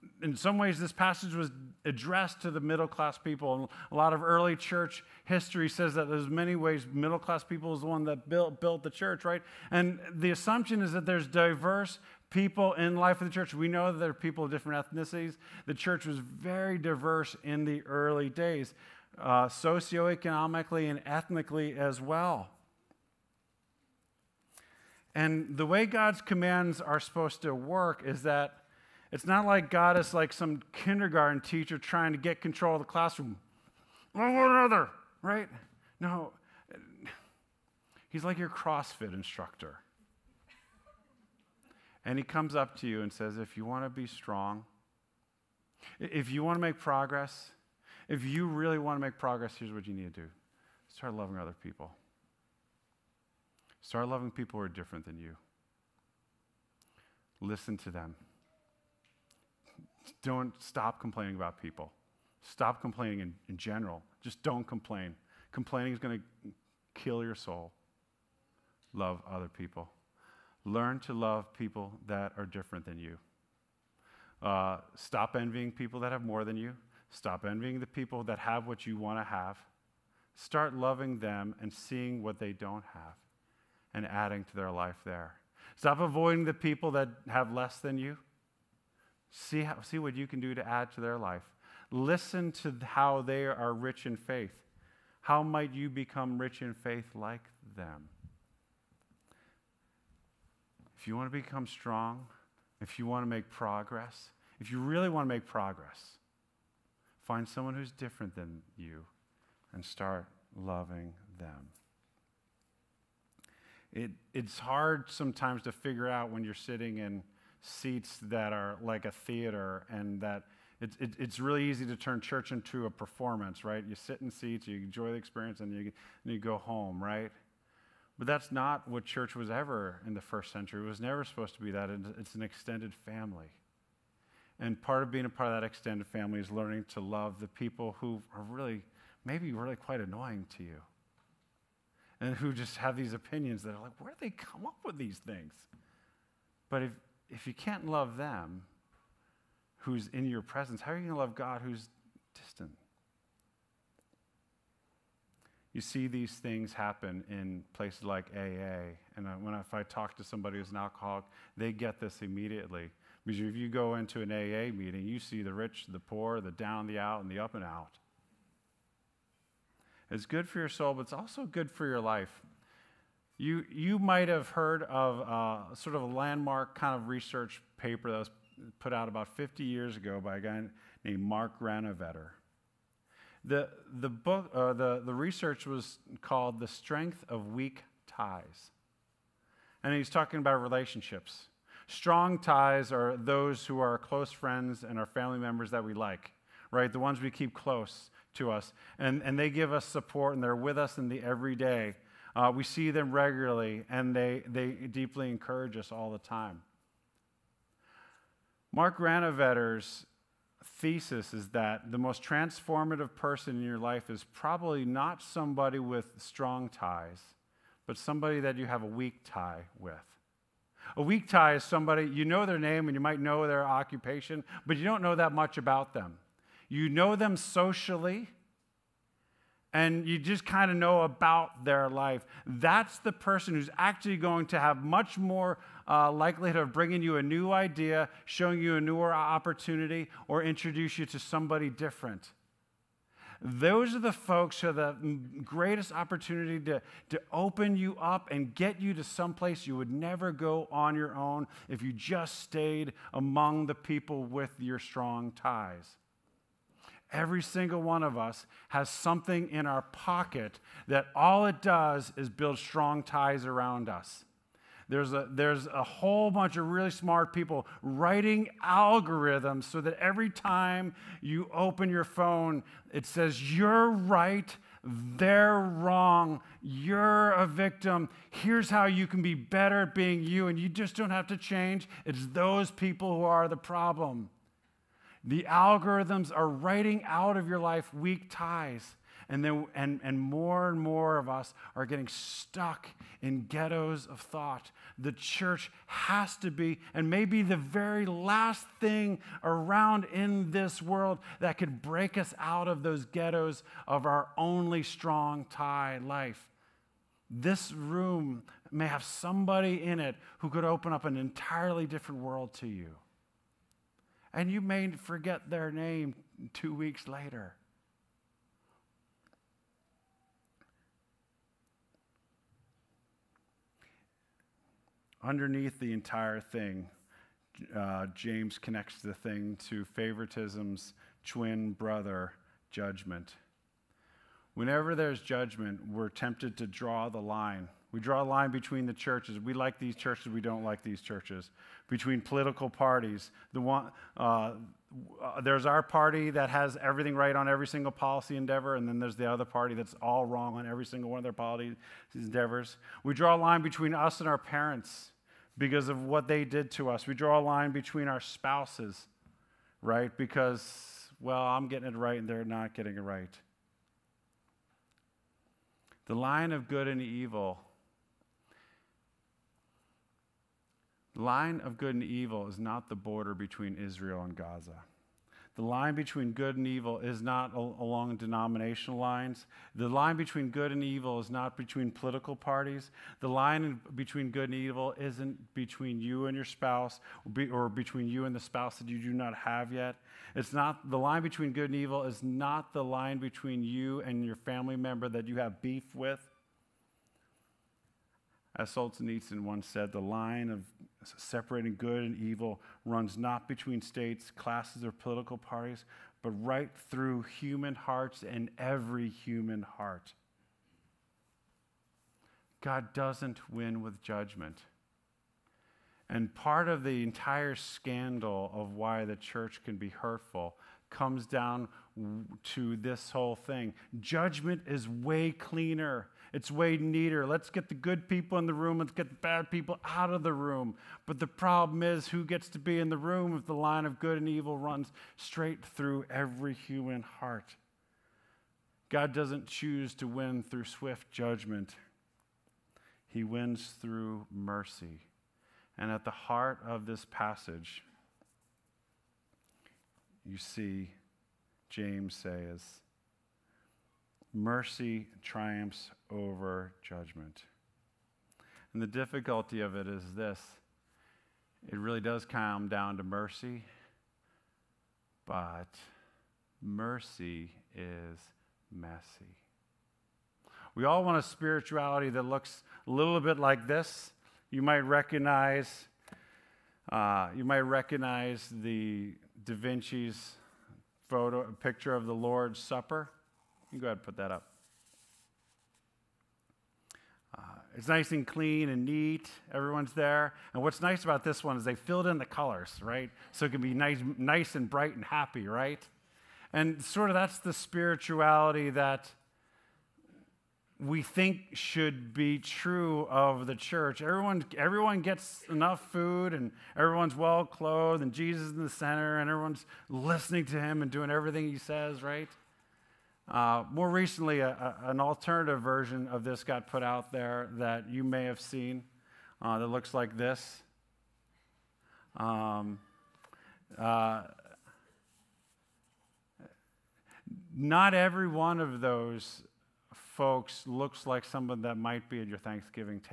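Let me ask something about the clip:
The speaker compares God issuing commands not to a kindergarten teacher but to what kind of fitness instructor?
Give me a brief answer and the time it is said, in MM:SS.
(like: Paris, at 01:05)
CrossFit, at 00:38.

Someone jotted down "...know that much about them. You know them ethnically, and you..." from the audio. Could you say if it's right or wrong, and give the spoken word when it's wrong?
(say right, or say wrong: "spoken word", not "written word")
wrong: "socially", not "ethnically".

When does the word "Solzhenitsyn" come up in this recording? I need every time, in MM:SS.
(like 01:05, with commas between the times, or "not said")
06:38.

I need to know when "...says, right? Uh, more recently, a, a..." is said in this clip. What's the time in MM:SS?
08:31.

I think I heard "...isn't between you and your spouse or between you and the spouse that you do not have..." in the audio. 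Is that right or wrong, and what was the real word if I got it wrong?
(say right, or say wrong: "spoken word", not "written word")
right.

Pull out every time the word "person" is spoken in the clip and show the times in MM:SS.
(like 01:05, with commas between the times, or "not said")
03:33, 03:53.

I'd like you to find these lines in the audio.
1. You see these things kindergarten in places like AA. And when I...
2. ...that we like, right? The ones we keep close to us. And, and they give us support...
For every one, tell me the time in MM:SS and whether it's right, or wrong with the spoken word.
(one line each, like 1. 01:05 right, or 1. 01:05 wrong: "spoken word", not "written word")
1. 02:35 wrong: "happen", not "kindergarten"
2. 03:15 right.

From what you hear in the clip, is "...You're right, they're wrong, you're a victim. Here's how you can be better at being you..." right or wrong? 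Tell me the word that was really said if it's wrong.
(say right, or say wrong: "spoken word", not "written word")
right.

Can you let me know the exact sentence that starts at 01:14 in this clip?
Uh, stop envying people that have more than you.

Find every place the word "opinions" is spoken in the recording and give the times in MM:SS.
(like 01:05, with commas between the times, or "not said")
02:23.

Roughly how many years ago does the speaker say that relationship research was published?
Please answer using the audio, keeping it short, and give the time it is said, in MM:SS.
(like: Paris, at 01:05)
50, at 02:59.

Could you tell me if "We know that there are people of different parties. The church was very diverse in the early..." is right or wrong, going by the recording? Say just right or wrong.
wrong.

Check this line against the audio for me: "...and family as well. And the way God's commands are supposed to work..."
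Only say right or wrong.
wrong.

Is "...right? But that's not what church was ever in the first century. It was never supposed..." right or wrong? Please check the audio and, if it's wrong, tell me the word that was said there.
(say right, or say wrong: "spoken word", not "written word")
right.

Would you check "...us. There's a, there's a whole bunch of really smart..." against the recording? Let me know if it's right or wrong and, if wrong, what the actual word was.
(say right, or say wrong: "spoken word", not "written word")
right.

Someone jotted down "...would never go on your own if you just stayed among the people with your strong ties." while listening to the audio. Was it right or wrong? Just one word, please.
right.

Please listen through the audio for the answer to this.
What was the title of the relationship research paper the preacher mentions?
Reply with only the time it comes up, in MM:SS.
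03:06.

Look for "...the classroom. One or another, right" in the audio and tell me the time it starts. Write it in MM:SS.
00:32.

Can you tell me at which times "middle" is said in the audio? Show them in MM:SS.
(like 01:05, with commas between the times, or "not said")
00:02, 00:06.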